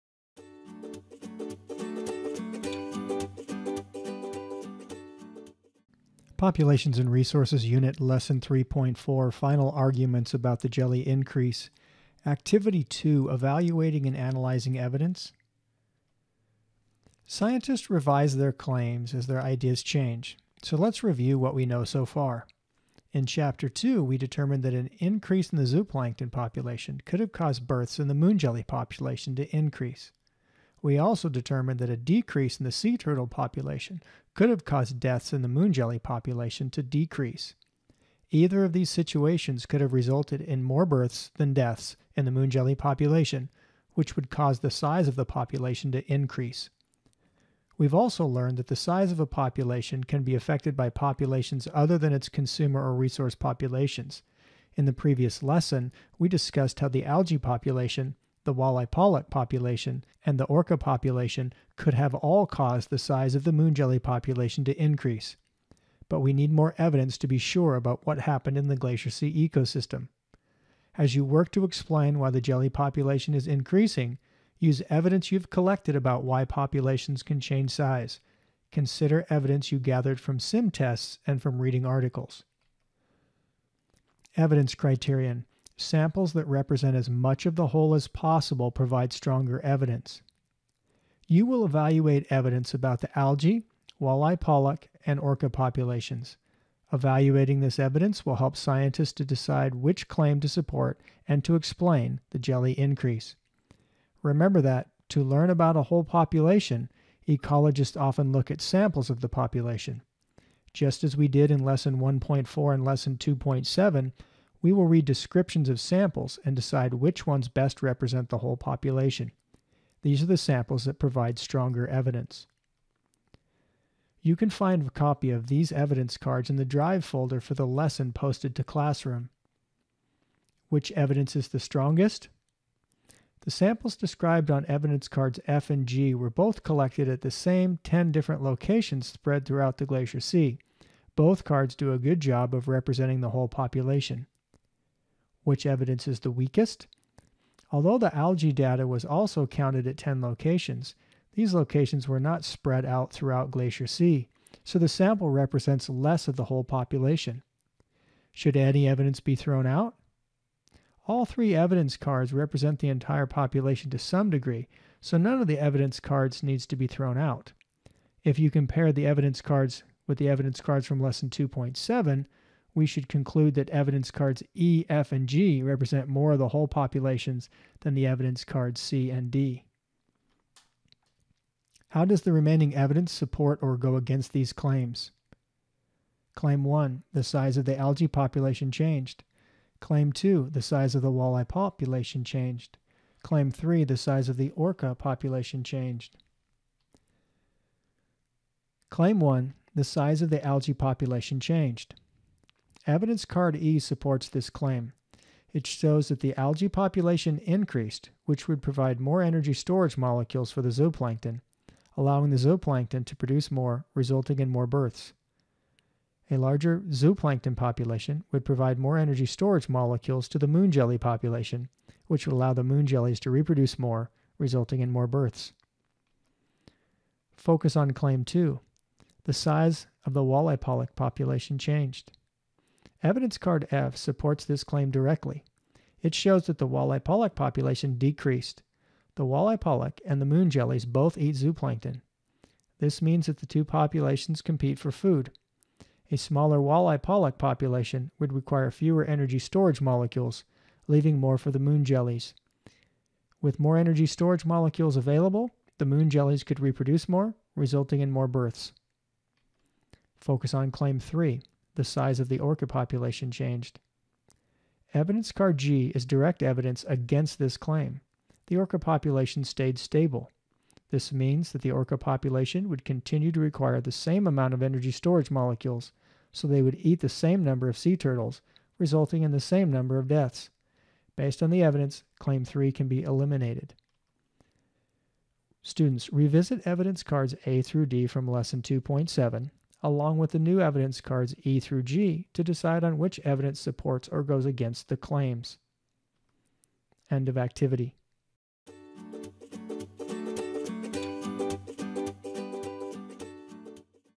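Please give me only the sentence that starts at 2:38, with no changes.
Should any evidence be thrown out?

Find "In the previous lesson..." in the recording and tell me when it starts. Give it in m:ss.
0:54.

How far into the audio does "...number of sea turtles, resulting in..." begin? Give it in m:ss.
4:37.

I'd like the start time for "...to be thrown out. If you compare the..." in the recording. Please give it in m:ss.
2:46.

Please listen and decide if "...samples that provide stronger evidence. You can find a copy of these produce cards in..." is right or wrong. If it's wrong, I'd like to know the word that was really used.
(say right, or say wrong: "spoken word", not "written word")
wrong: "evidence", not "produce".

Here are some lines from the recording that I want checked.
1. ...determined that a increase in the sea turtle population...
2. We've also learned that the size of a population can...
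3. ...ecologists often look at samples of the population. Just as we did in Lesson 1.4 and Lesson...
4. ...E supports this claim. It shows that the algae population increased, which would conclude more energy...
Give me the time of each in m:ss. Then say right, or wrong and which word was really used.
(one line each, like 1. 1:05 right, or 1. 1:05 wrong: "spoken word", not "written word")
1. 0:31 wrong: "decrease", not "increase"
2. 0:47 right
3. 1:47 right
4. 3:23 wrong: "provide", not "conclude".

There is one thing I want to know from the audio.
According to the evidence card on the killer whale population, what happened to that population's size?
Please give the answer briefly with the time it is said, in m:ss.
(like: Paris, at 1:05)
stayed stable, at 4:29.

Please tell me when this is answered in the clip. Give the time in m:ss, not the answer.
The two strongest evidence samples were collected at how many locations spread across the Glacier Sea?
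2:17.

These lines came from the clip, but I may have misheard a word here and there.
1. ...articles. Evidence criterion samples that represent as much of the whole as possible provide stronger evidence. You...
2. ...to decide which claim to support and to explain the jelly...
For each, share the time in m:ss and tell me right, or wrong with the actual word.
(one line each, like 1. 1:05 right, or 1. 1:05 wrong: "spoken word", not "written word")
1. 1:21 right
2. 1:39 right.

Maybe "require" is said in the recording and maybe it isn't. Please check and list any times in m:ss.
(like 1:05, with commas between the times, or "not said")
4:08, 4:33.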